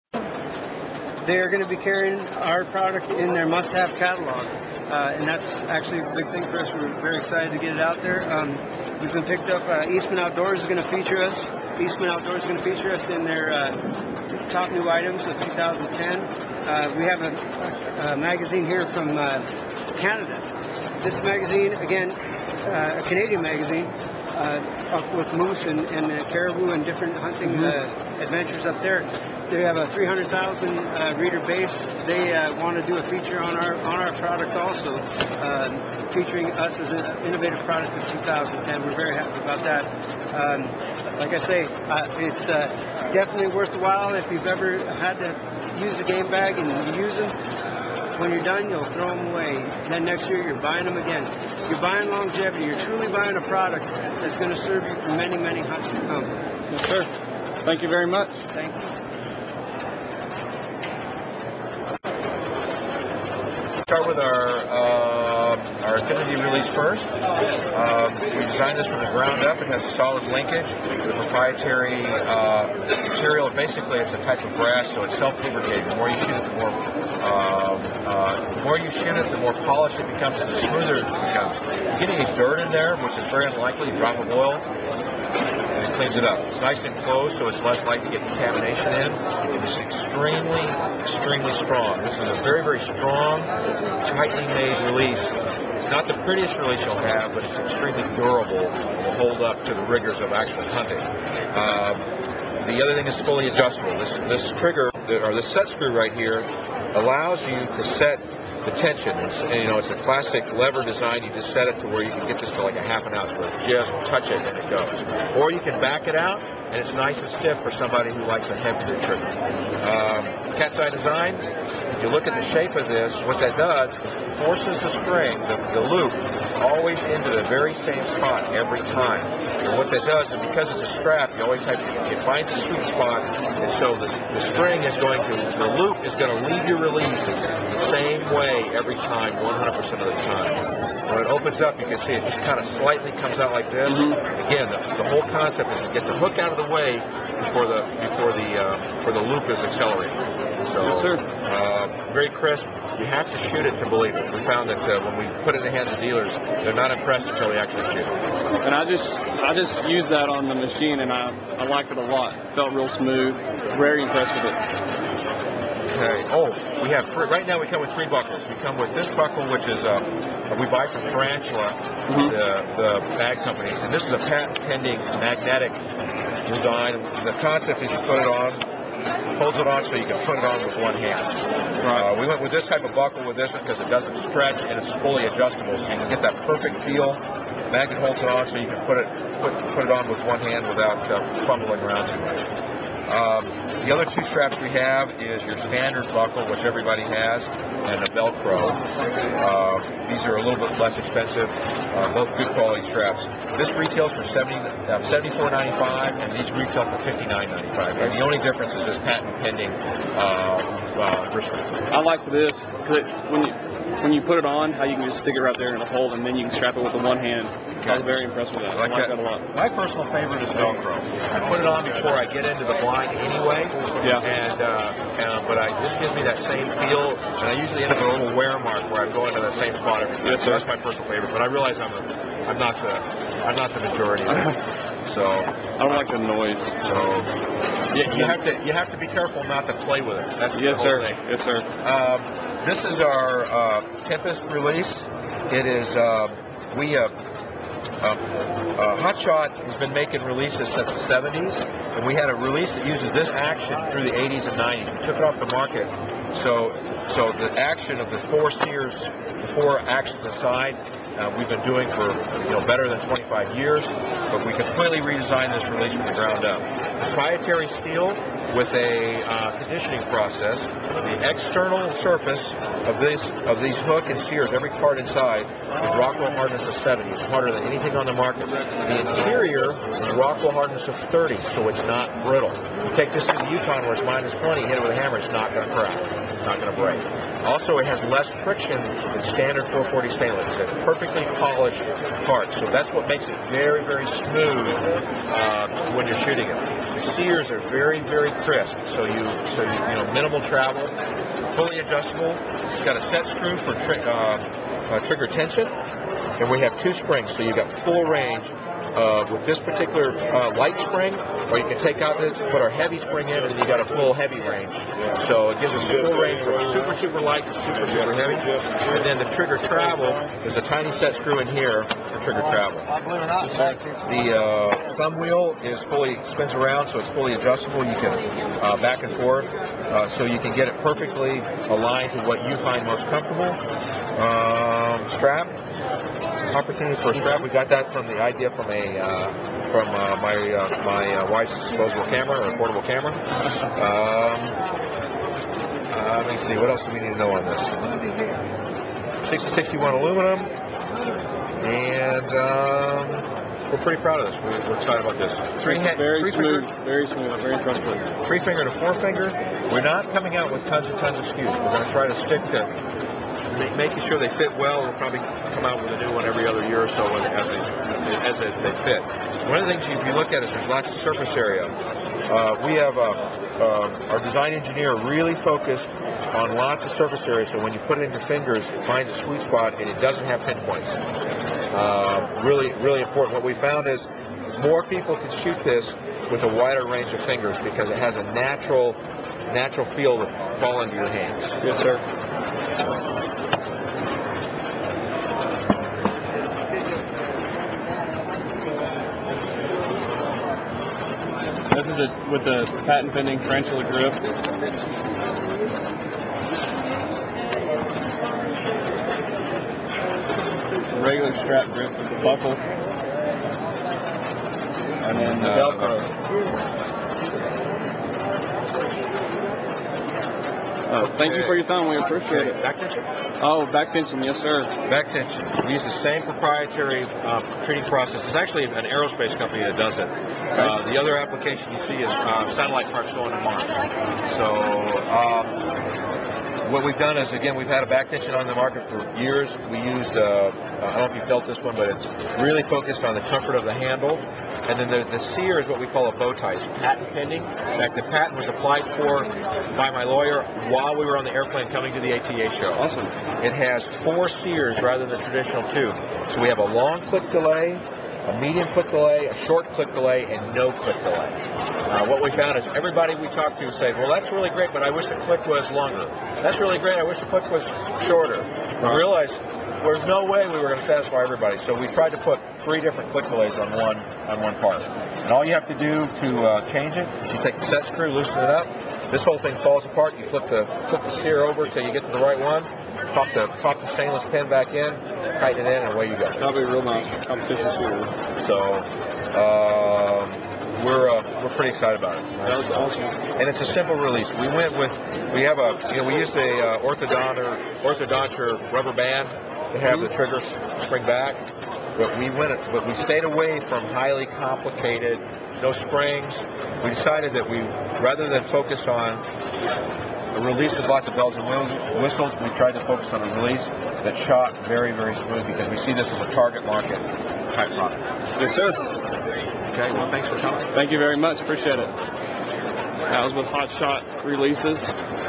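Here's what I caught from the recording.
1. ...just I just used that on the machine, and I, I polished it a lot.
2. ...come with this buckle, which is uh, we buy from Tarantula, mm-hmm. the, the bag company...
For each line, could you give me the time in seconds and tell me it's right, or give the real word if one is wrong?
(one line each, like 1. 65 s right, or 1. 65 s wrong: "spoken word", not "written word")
1. 158 s wrong: "liked", not "polished"
2. 168 s right.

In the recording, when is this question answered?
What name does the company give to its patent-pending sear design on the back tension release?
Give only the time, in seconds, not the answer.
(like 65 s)
446 s.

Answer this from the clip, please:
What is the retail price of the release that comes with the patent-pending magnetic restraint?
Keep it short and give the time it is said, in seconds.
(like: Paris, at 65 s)
$74.95, at 205 s.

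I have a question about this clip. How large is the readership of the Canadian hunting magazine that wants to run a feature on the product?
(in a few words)
300,000.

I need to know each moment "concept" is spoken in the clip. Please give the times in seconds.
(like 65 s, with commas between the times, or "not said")
145 s, 177 s.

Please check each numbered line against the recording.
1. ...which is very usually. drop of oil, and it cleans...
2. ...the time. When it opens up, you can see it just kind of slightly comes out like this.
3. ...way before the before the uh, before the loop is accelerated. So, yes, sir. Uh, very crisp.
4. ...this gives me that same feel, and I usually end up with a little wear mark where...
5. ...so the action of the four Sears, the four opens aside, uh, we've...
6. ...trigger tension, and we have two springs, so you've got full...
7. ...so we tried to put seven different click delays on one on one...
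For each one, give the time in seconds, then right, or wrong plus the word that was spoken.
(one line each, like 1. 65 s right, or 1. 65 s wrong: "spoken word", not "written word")
1. 82 s wrong: "unlikely", not "usually"
2. 139 s right
3. 146 s right
4. 225 s right
5. 257 s wrong: "actions", not "opens"
6. 305 s right
7. 471 s wrong: "three", not "seven".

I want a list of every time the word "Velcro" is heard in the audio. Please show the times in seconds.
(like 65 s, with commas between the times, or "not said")
198 s, 220 s, 415 s.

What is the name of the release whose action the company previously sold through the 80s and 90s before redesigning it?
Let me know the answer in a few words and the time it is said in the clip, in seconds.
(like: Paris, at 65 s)
Tempest, at 244 s.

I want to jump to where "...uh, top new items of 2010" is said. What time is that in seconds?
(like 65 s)
13 s.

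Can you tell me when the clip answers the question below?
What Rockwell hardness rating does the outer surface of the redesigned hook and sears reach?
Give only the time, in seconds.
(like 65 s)
275 s.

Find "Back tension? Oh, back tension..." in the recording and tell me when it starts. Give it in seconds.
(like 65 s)
422 s.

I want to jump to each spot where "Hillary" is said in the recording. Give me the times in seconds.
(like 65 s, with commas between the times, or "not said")
not said.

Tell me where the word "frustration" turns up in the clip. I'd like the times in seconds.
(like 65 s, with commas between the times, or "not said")
not said.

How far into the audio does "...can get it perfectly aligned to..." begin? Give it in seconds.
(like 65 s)
330 s.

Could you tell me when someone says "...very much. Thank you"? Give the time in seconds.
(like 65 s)
57 s.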